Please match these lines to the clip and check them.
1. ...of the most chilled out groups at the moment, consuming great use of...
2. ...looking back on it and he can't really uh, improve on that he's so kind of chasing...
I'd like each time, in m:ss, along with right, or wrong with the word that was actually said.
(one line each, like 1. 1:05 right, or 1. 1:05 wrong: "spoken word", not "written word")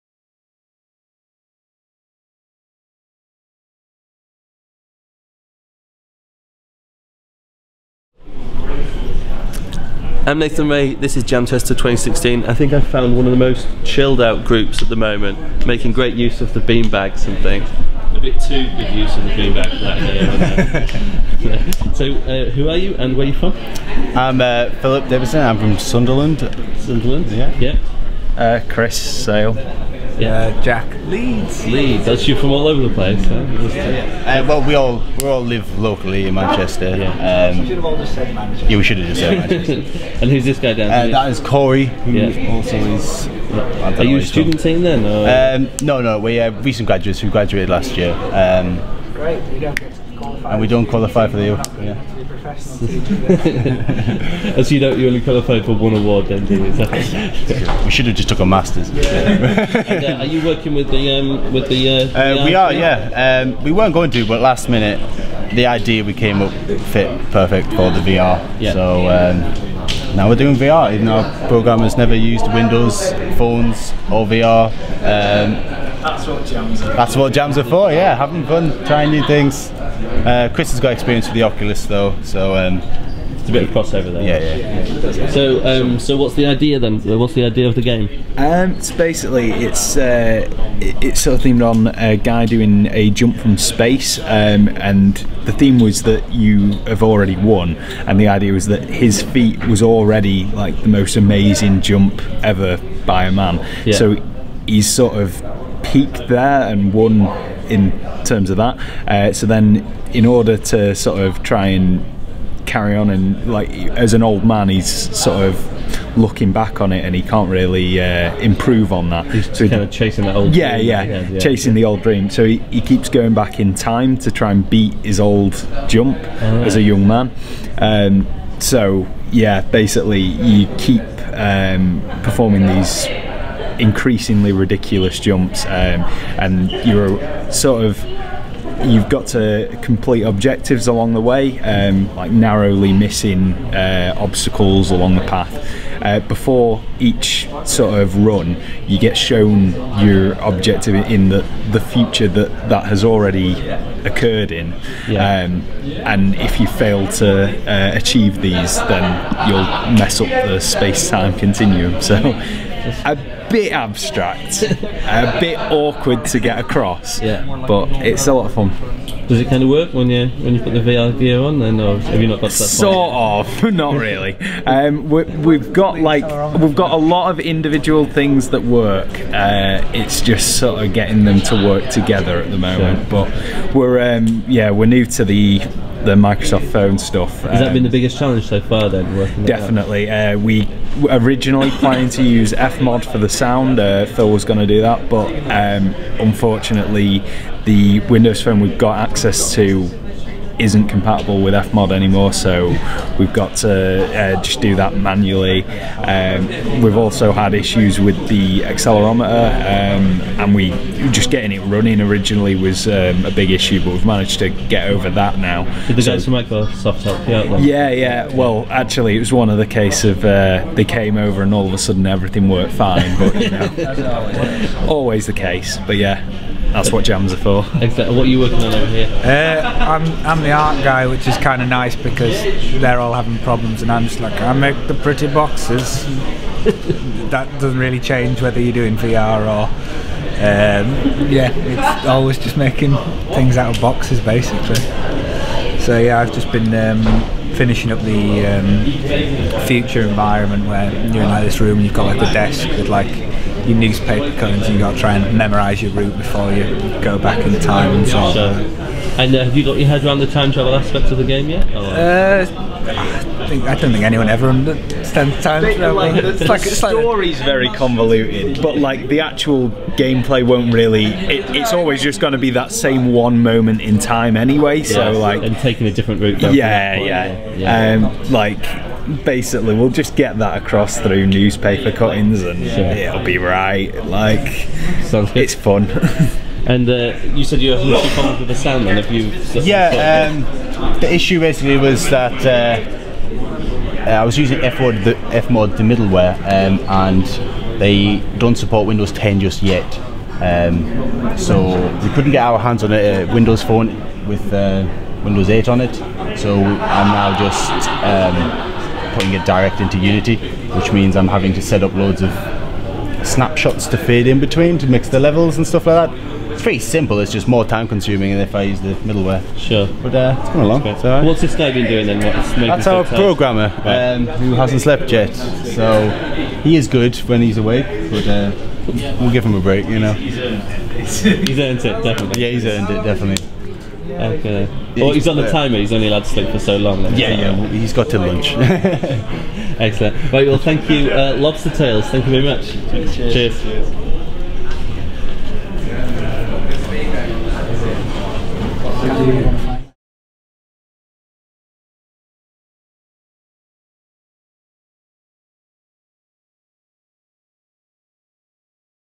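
1. 0:13 wrong: "making", not "consuming"
2. 1:56 right.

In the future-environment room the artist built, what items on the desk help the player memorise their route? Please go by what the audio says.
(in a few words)
newspaper cuttings.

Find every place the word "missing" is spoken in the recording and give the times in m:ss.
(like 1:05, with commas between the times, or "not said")
2:22.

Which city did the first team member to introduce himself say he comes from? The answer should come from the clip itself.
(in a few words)
Sunderland.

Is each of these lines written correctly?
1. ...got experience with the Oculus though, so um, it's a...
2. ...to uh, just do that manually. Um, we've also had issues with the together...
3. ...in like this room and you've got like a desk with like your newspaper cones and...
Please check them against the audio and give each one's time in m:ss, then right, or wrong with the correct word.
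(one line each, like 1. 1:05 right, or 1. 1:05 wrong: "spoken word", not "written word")
1. 1:20 right
2. 3:23 wrong: "accelerometer", not "together"
3. 4:11 right.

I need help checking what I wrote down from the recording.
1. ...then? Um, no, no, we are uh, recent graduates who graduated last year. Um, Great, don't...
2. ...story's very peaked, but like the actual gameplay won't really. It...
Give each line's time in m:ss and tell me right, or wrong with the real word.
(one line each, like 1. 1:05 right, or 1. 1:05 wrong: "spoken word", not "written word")
1. 0:44 right
2. 4:26 wrong: "convoluted", not "peaked".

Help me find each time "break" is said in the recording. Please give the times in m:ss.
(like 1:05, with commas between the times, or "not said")
5:29.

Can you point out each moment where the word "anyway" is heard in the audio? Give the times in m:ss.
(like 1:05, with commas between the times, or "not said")
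4:34.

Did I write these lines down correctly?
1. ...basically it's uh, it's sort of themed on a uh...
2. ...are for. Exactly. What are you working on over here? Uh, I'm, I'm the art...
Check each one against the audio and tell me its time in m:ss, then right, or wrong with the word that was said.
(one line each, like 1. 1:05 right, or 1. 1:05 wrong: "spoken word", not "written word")
1. 1:28 right
2. 3:47 right.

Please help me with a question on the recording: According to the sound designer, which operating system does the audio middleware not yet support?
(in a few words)
Windows 10.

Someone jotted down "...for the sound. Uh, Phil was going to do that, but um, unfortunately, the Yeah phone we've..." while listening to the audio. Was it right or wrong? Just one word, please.
wrong.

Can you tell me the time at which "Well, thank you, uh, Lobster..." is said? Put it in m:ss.
5:40.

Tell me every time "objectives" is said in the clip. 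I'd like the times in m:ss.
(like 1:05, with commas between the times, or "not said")
2:20, 2:30.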